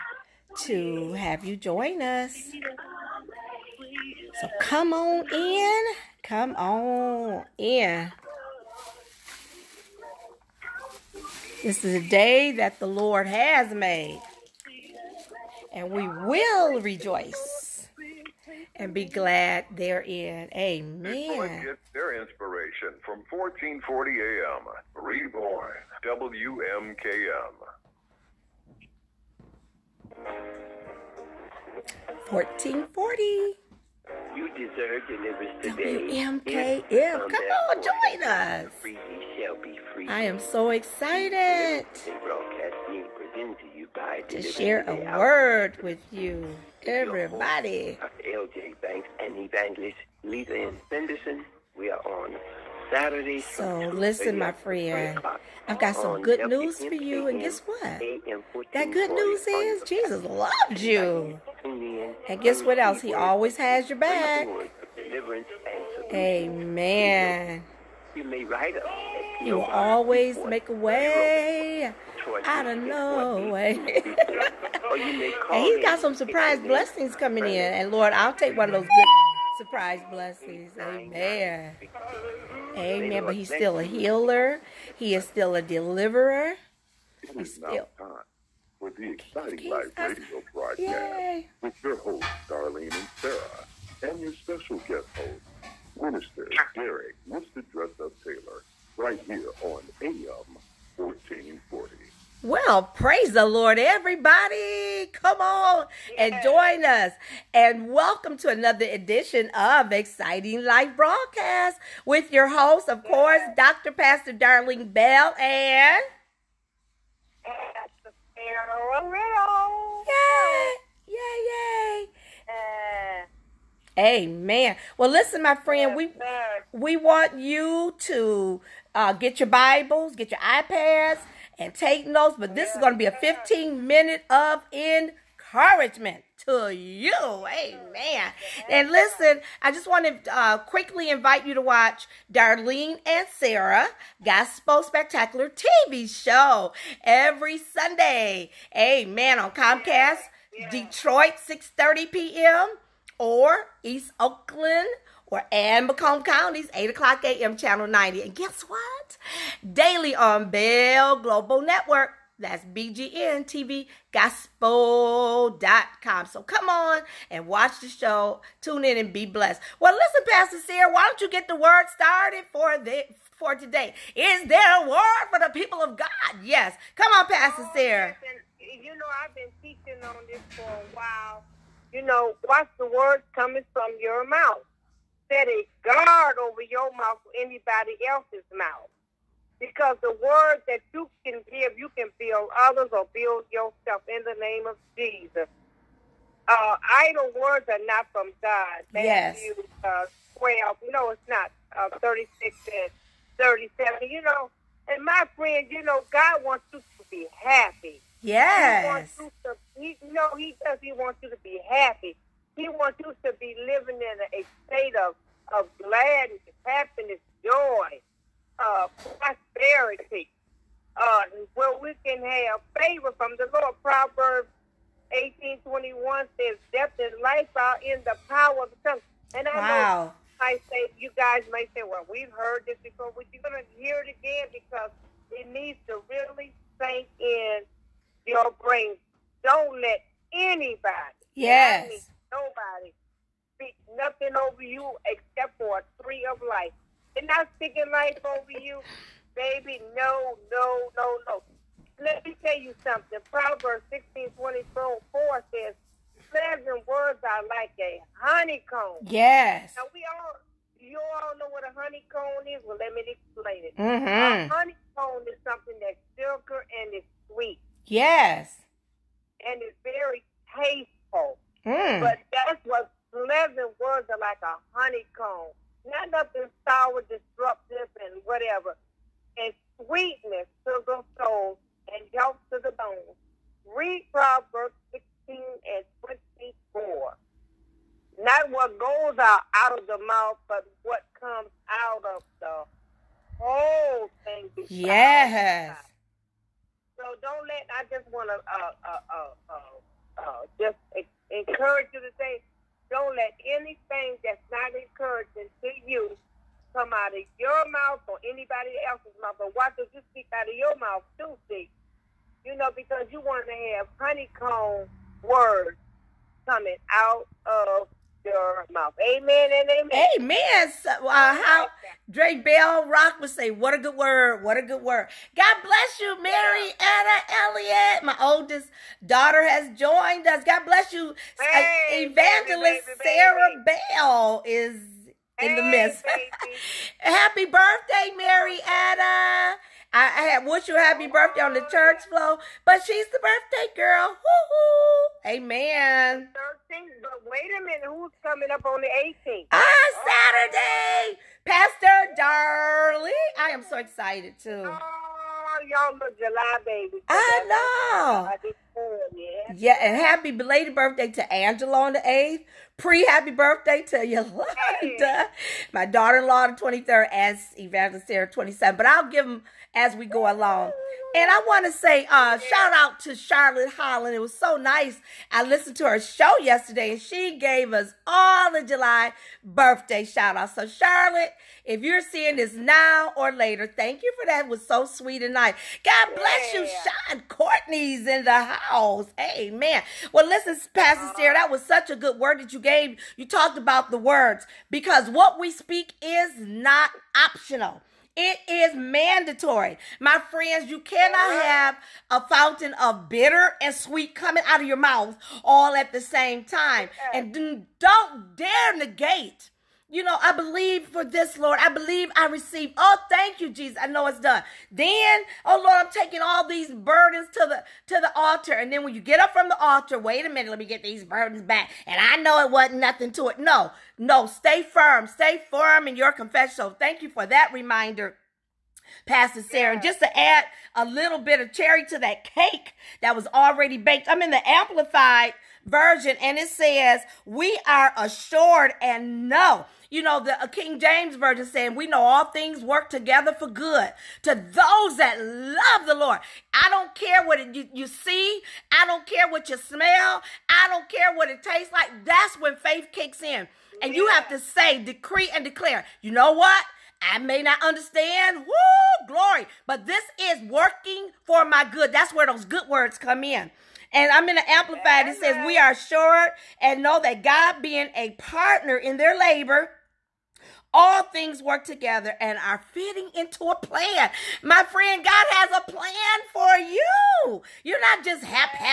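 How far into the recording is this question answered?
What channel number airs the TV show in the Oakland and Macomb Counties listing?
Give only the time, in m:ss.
2:37.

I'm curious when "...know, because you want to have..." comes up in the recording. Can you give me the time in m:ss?
5:12.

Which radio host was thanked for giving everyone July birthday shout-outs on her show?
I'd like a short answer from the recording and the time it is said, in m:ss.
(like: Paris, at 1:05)
Charlotte Holland, at 6:13.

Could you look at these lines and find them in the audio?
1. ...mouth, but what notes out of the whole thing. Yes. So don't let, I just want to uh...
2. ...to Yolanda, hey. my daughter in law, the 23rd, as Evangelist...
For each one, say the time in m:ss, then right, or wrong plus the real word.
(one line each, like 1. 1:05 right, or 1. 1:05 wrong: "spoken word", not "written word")
1. 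4:50 wrong: "comes", not "notes"
2. 6:03 right.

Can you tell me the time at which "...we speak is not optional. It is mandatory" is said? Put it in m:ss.
6:35.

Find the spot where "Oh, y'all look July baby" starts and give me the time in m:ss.
5:54.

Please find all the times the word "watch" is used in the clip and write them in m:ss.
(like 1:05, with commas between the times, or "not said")
2:21, 2:47, 3:02.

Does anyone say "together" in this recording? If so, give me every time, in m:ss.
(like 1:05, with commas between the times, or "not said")
7:22, 7:51.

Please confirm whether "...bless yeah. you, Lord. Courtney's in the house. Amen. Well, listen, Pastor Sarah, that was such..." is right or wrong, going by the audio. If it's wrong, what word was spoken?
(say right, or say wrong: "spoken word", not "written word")
wrong: "Sean", not "Lord".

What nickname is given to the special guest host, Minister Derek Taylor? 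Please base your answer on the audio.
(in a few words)
Mr. Dress Up.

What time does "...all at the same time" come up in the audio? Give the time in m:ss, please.
6:45.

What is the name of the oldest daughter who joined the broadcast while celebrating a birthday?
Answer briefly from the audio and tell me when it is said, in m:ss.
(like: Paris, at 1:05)
Mary Anna Elliott, at 5:26.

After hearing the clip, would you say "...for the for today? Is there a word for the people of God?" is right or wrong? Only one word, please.
right.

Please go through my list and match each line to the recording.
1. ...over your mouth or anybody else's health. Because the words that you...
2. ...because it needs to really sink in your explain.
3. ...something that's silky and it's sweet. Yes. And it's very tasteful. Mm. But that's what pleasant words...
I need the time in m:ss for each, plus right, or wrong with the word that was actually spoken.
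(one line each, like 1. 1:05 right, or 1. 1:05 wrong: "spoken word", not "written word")
1. 3:06 wrong: "mouth", not "health"
2. 3:54 wrong: "brain", not "explain"
3. 4:25 right.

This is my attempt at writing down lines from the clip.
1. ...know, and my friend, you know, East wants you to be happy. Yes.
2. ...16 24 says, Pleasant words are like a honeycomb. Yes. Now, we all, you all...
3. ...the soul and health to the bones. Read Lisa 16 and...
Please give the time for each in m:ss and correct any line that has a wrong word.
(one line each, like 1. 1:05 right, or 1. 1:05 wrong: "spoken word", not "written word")
1. 3:24 wrong: "God", not "East"
2. 4:13 right
3. 4:40 wrong: "Proverbs", not "Lisa".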